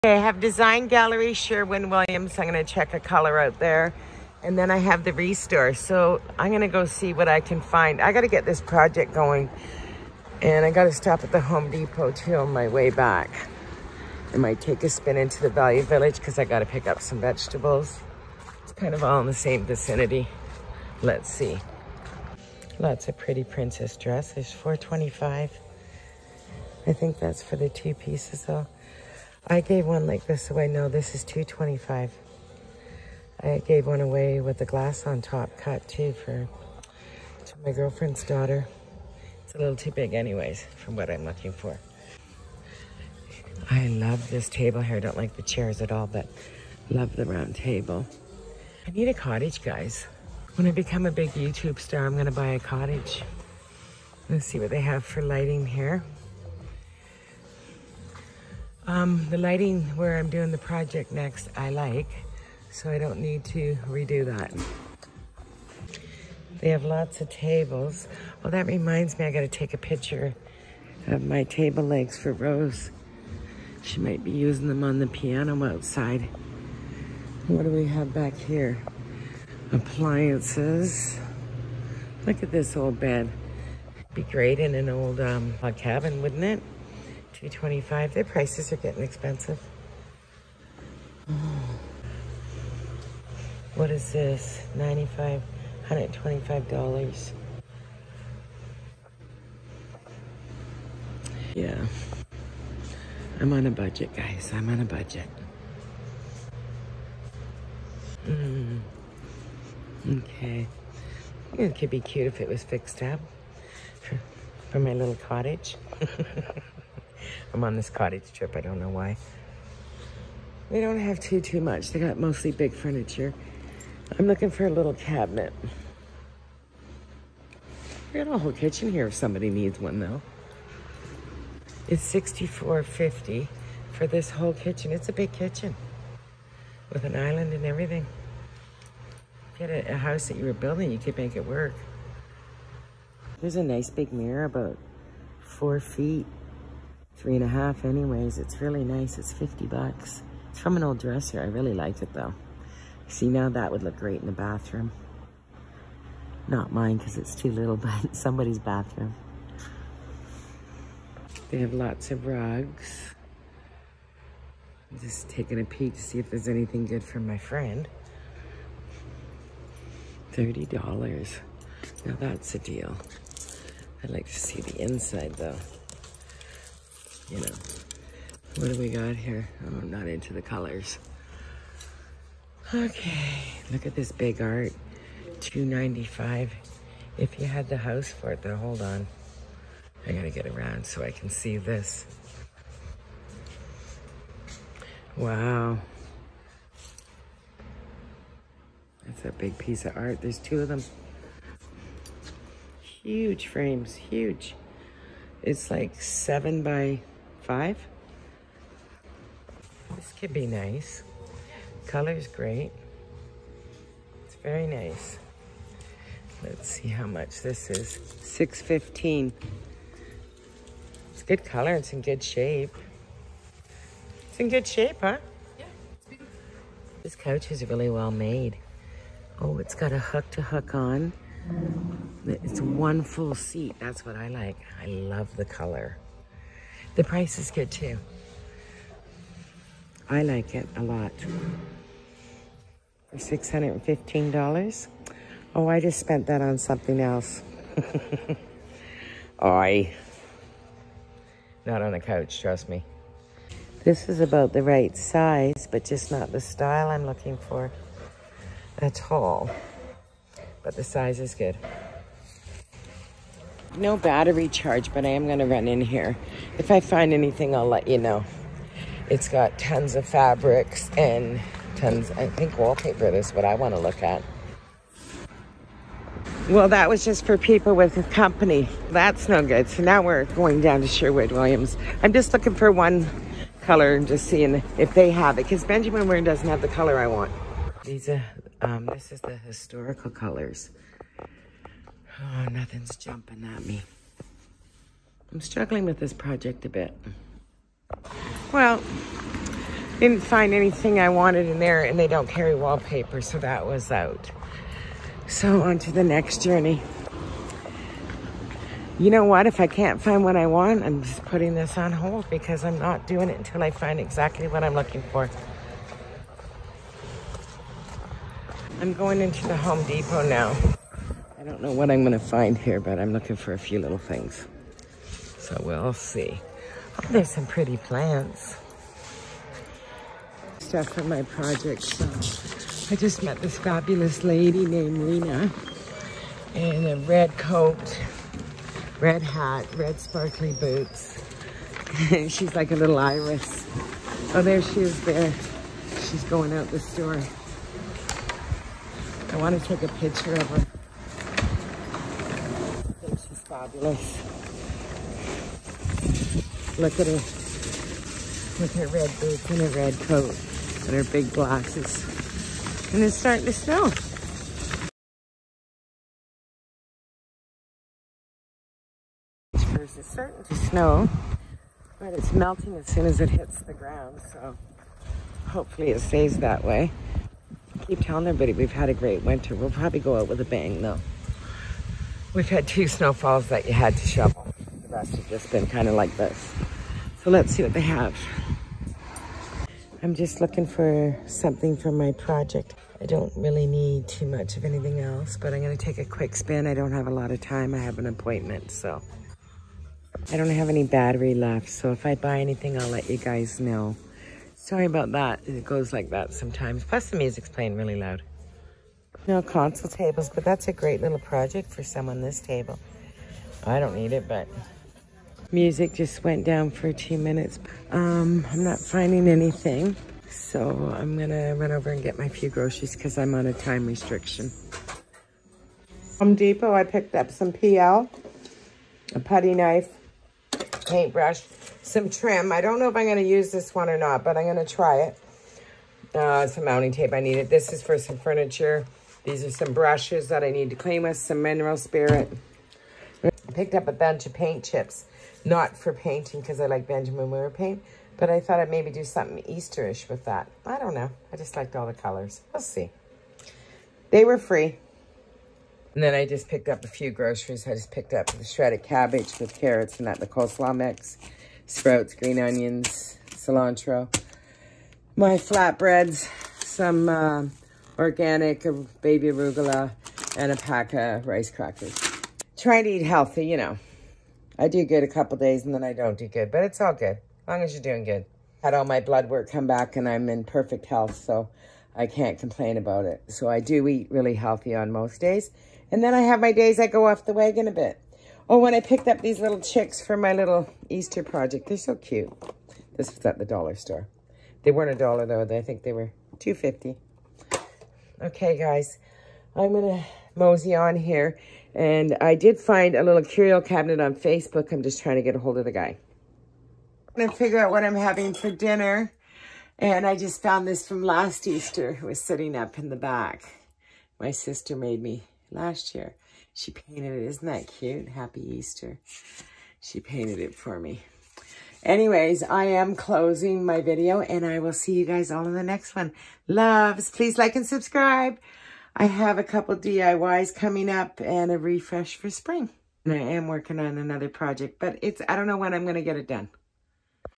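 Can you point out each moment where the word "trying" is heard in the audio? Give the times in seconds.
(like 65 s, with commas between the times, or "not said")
472 s, 505 s.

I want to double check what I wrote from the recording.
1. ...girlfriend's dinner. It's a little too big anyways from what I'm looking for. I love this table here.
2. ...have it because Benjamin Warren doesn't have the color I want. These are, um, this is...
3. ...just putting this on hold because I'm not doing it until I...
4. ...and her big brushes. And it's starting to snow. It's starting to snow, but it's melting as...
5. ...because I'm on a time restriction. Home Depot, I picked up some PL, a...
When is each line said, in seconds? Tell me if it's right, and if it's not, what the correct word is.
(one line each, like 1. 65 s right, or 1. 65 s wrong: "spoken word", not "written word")
1. 37 s wrong: "daughter", not "dinner"
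2. 285 s right
3. 311 s right
4. 360 s wrong: "glasses", not "brushes"
5. 422 s right.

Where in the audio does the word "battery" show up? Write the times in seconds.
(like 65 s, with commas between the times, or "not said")
263 s, 400 s.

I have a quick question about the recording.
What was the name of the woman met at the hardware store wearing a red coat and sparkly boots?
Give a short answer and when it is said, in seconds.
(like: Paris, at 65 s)
Lena, at 334 s.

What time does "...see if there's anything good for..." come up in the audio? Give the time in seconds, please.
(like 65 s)
166 s.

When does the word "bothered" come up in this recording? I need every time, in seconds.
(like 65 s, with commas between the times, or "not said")
not said.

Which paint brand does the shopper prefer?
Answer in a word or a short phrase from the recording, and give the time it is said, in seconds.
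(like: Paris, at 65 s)
Benjamin Moore, at 446 s.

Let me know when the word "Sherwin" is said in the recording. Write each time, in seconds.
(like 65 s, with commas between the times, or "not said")
1 s, 280 s.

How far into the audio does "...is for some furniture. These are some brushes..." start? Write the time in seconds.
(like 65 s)
437 s.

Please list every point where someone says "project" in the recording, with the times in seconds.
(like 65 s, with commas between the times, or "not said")
8 s, 60 s, 296 s, 331 s, 392 s, 411 s, 491 s, 534 s.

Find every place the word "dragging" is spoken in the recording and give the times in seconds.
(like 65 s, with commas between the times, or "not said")
not said.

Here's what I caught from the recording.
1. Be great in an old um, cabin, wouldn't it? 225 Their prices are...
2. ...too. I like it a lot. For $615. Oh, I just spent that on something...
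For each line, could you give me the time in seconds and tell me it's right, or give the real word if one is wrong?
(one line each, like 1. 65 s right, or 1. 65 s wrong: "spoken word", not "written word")
1. 84 s right
2. 237 s right.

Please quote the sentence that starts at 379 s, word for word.
We'll probably go out with a bang though.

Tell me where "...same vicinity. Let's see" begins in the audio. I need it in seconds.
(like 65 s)
19 s.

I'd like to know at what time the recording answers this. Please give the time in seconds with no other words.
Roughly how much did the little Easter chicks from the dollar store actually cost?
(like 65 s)
496 s.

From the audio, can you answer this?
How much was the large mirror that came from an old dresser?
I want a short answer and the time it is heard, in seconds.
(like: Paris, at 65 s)
$50, at 149 s.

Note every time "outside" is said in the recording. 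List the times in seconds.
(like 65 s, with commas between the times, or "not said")
75 s.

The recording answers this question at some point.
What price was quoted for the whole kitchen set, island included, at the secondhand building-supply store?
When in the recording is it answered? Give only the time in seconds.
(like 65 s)
132 s.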